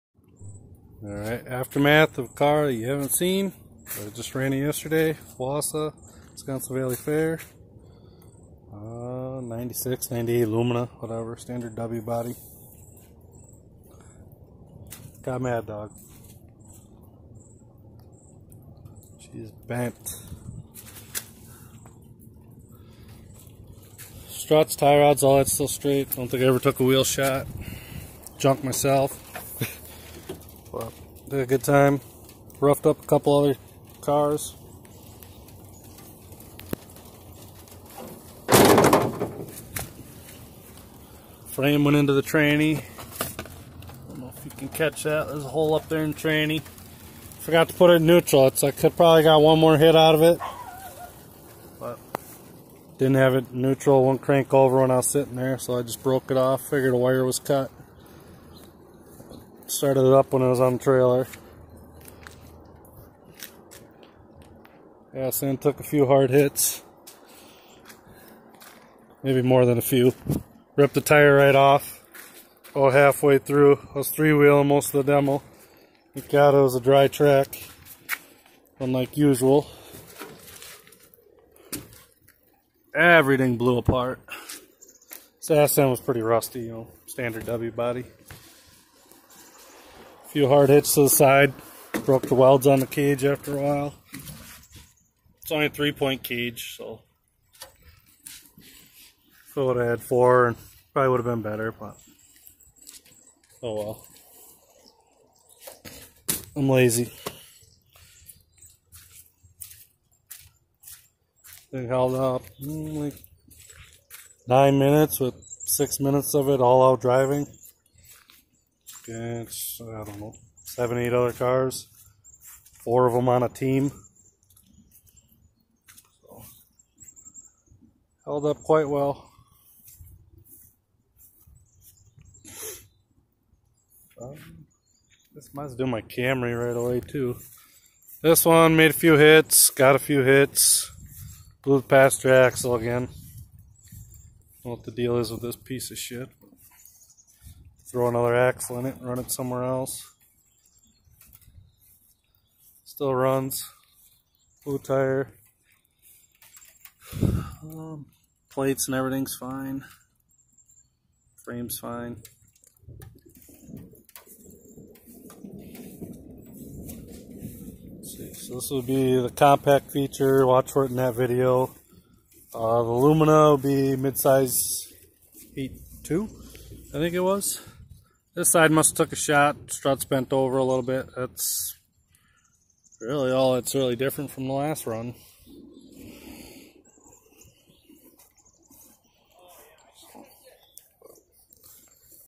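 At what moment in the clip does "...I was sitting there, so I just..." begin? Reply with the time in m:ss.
0:54.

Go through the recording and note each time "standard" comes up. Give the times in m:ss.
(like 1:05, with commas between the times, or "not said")
0:11, 1:27.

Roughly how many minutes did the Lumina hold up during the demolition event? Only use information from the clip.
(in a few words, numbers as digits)
9.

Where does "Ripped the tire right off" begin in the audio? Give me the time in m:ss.
1:10.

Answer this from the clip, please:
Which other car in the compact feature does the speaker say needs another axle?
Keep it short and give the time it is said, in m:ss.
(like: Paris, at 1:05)
Camry, at 2:16.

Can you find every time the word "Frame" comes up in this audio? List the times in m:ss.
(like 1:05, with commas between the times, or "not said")
0:41, 2:41.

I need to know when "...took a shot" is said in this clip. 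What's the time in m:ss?
2:59.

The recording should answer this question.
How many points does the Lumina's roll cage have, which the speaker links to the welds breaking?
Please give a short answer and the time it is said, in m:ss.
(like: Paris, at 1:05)
3, at 1:35.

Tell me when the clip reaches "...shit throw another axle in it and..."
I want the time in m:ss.
2:25.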